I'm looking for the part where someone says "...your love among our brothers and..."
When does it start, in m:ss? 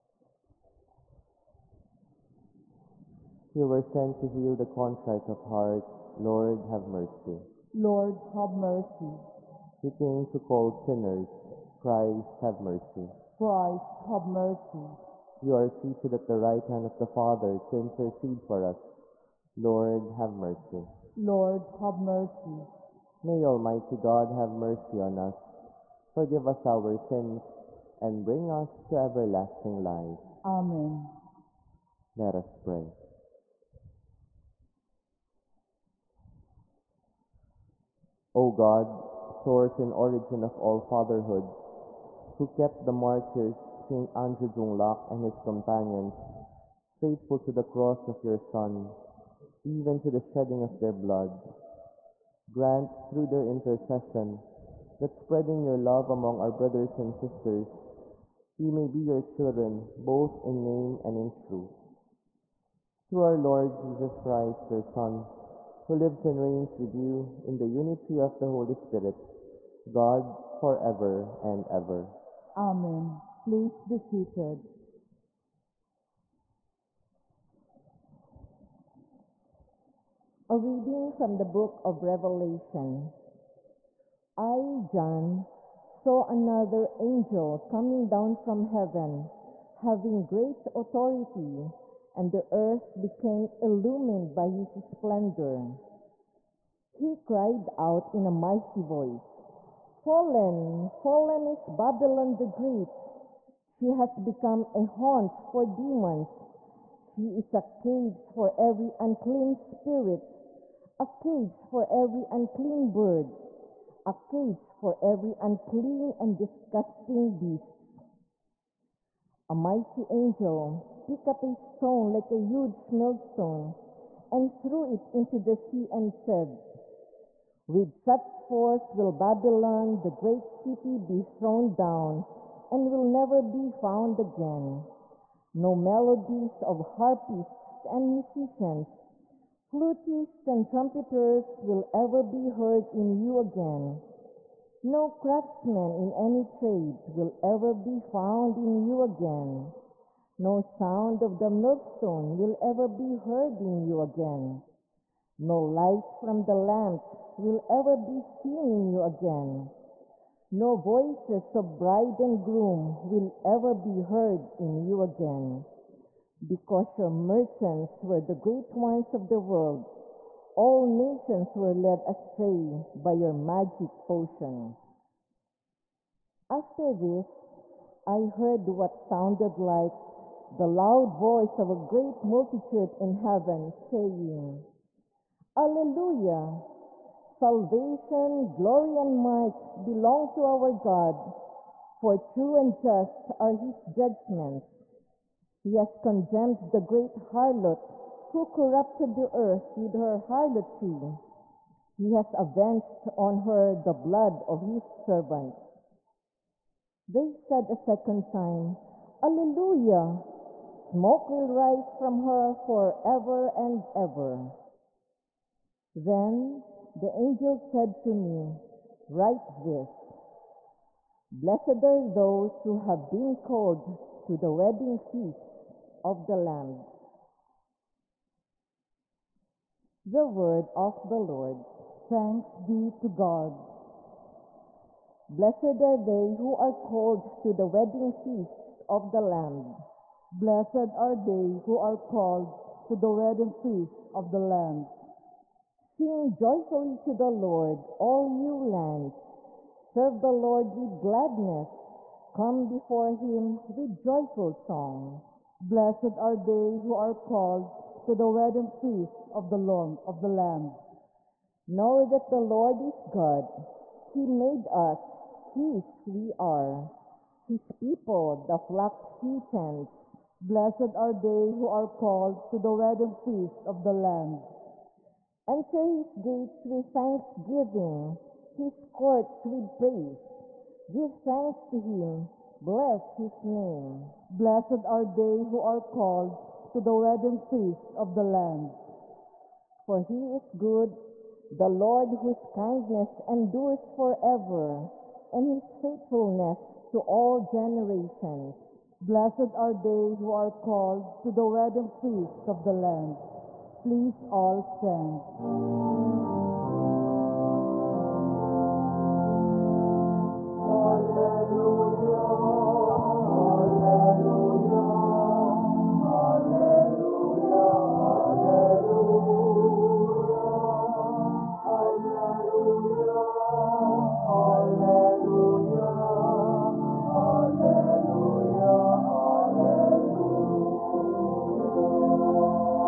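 0:55.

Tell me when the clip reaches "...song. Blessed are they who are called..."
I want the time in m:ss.
4:14.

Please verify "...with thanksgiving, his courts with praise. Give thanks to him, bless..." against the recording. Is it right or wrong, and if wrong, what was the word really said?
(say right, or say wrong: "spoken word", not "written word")
right.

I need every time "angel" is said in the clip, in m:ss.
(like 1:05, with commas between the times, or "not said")
1:26, 2:00, 3:37.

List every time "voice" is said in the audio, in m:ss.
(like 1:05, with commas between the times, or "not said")
1:38, 2:40, 3:01.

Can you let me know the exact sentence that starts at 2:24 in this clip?
No craftsman in any trade will ever be found in you again.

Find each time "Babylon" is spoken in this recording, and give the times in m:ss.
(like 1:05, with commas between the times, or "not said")
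1:41, 2:09.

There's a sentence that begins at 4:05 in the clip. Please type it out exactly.
Sing joyfully to the Lord, all you lands.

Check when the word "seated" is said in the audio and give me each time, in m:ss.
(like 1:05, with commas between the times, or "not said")
0:15, 1:13.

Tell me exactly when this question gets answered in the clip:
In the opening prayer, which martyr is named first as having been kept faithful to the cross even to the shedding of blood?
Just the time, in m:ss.
0:43.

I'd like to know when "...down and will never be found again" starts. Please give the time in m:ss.
2:11.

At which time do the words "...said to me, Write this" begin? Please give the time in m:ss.
3:37.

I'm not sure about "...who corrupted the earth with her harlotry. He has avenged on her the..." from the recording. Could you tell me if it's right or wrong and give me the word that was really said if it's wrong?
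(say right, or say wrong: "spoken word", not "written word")
right.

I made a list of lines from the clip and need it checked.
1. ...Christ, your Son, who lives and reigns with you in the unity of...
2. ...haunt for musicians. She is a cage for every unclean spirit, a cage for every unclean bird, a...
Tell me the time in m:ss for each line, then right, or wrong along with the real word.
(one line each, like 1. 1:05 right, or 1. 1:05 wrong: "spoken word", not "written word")
1. 1:04 right
2. 1:44 wrong: "demons", not "musicians".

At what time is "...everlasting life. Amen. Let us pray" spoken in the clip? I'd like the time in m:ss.
0:28.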